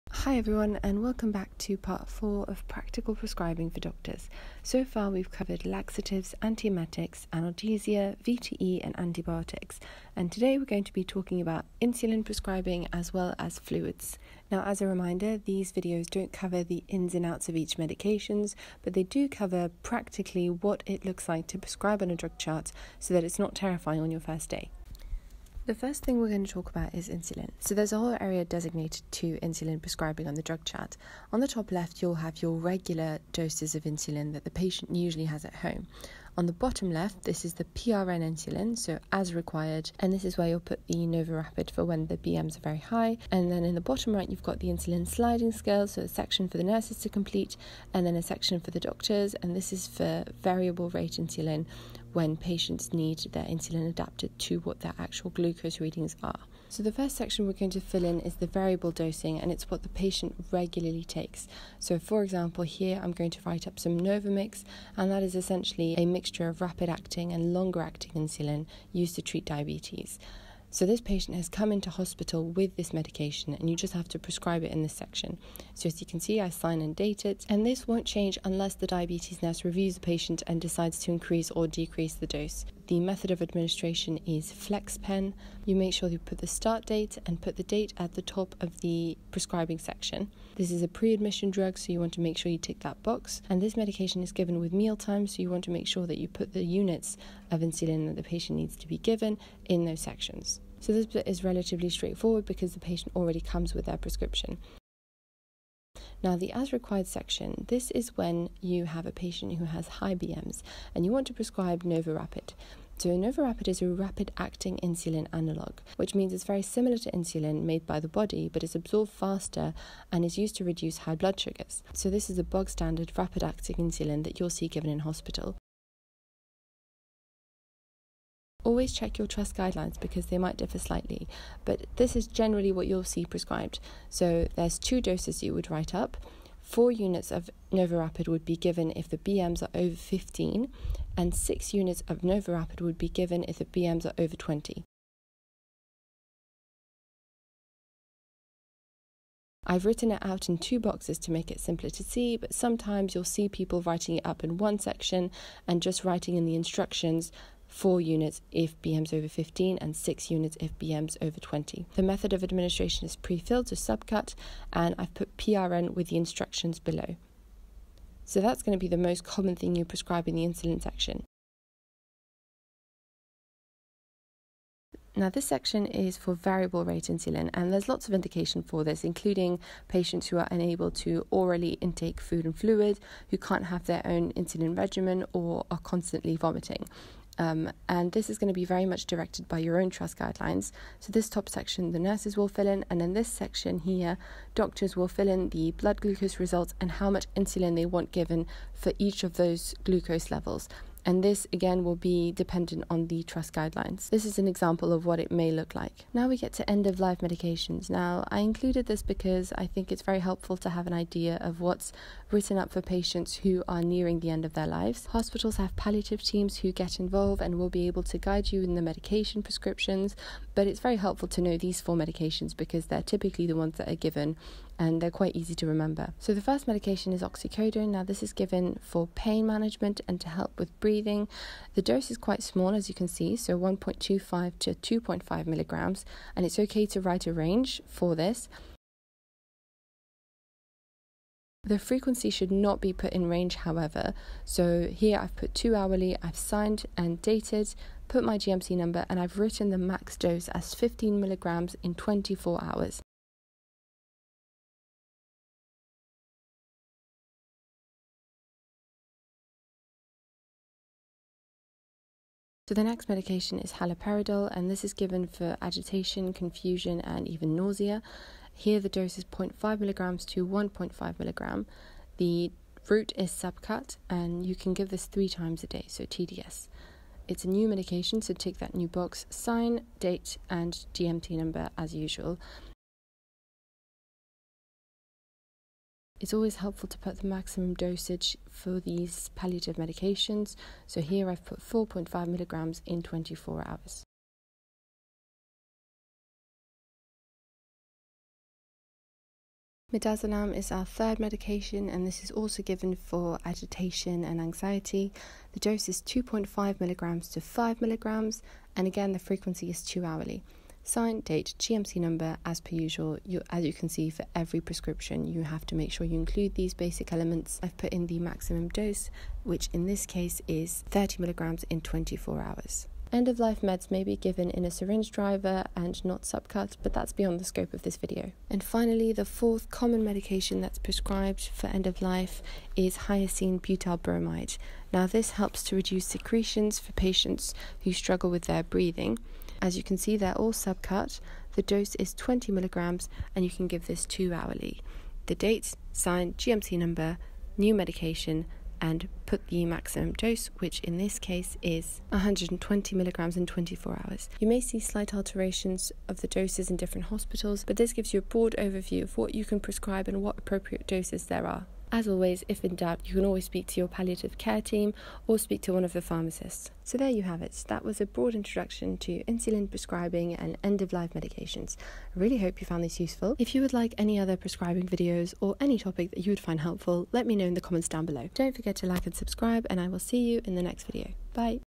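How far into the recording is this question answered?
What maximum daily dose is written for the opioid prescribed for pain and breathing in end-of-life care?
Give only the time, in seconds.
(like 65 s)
250 s.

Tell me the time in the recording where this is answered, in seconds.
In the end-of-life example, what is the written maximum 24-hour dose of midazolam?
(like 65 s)
320 s.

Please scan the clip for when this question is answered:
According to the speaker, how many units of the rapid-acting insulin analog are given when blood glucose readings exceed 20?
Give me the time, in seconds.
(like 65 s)
141 s.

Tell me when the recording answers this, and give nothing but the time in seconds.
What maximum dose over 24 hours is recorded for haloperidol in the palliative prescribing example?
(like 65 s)
291 s.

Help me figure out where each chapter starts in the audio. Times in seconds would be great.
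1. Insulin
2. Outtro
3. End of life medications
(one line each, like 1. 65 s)
1. 28 s
2. 372 s
3. 206 s.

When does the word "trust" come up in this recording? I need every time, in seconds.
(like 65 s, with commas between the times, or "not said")
129 s, 189 s, 203 s.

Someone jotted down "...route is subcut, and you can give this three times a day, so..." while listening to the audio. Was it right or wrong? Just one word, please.
right.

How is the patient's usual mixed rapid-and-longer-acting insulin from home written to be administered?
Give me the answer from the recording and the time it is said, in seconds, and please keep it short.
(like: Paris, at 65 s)
FlexPen, at 84 s.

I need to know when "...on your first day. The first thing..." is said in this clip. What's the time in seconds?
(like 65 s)
24 s.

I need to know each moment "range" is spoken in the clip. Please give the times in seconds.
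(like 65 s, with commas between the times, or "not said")
237 s, 243 s.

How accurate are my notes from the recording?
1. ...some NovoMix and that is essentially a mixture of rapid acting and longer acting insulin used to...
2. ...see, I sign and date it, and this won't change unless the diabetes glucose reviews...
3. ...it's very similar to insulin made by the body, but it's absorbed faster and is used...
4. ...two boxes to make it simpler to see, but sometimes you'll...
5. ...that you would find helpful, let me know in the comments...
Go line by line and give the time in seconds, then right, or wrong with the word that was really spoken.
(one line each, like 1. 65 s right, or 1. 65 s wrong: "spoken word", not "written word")
1. 63 s right
2. 76 s wrong: "nurse", not "glucose"
3. 116 s right
4. 150 s right
5. 376 s right.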